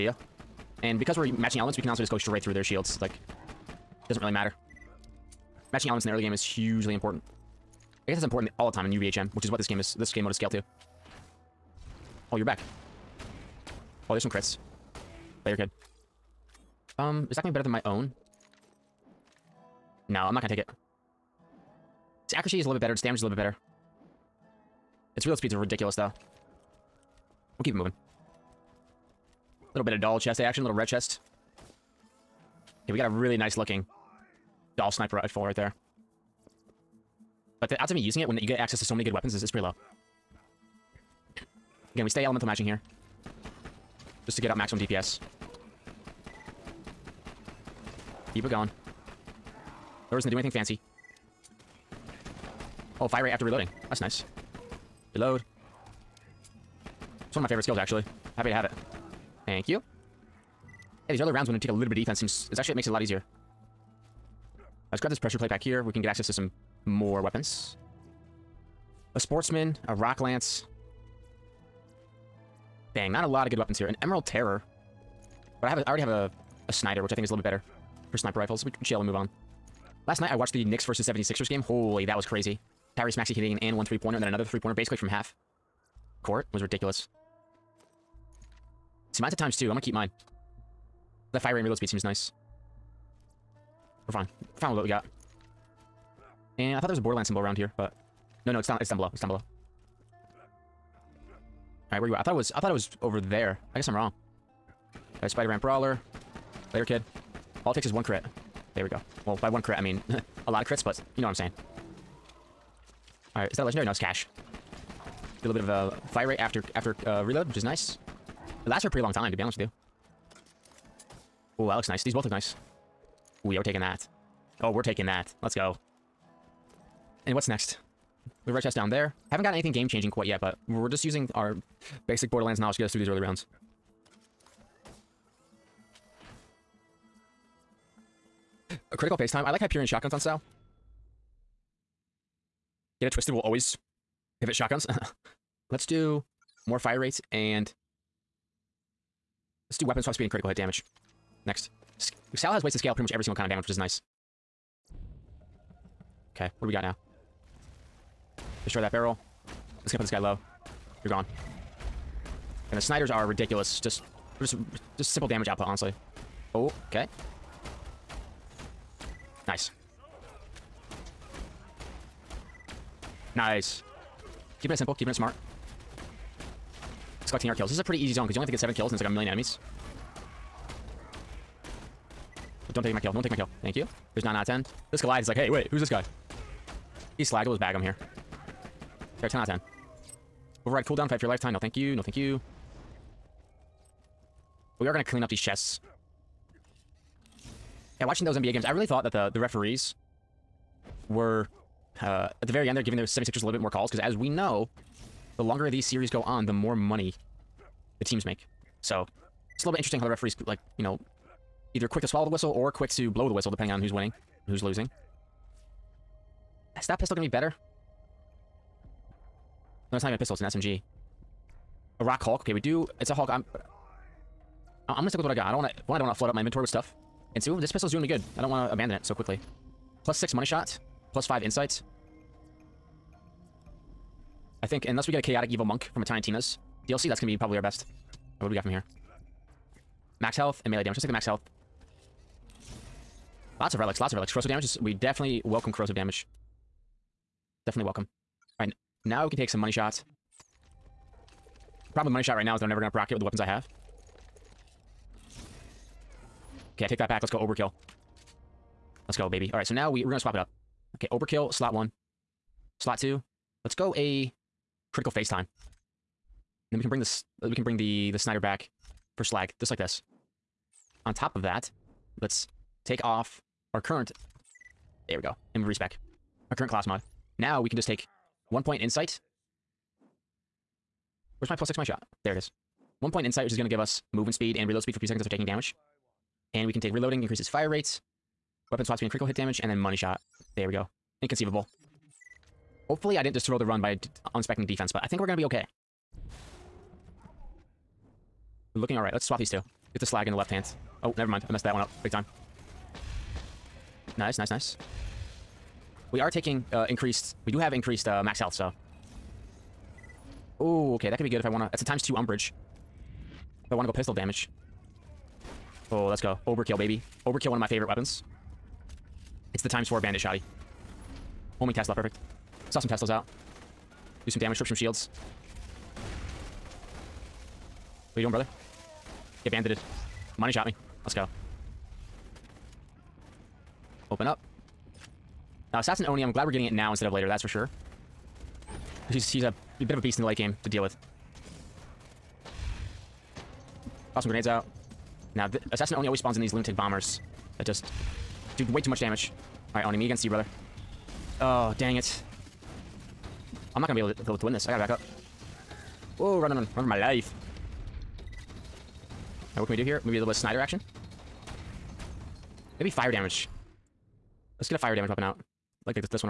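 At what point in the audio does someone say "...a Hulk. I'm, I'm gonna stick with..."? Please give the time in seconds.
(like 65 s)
223 s.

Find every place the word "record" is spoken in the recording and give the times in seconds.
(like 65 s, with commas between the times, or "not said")
not said.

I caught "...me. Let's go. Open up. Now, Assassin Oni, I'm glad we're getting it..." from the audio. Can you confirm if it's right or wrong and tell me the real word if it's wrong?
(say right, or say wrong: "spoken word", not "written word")
right.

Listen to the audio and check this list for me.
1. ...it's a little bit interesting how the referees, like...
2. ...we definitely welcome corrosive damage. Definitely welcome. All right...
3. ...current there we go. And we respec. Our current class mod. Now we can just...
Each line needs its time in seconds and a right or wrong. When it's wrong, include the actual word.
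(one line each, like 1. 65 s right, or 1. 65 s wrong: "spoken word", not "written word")
1. 209 s right
2. 244 s right
3. 273 s right.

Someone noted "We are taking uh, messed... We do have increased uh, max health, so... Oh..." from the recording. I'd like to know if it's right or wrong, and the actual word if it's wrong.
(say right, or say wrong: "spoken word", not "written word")
wrong: "increased", not "messed".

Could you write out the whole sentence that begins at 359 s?
Alright, what can we do here?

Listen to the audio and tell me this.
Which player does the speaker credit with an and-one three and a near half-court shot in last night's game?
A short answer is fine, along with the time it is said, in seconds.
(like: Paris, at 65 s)
Tyrese Maxey, at 82 s.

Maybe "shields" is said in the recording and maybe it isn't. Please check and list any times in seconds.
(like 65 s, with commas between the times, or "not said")
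2 s, 324 s.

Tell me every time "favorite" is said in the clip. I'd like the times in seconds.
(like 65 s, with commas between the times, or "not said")
57 s, 317 s.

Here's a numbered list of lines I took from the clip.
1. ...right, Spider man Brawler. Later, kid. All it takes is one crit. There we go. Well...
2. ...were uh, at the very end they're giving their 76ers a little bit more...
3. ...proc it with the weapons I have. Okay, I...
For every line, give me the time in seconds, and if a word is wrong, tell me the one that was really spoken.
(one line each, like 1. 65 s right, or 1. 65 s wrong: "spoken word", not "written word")
1. 105 s right
2. 201 s right
3. 252 s right.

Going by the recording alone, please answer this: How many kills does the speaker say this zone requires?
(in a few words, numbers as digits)
7.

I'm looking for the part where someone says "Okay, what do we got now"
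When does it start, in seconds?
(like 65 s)
156 s.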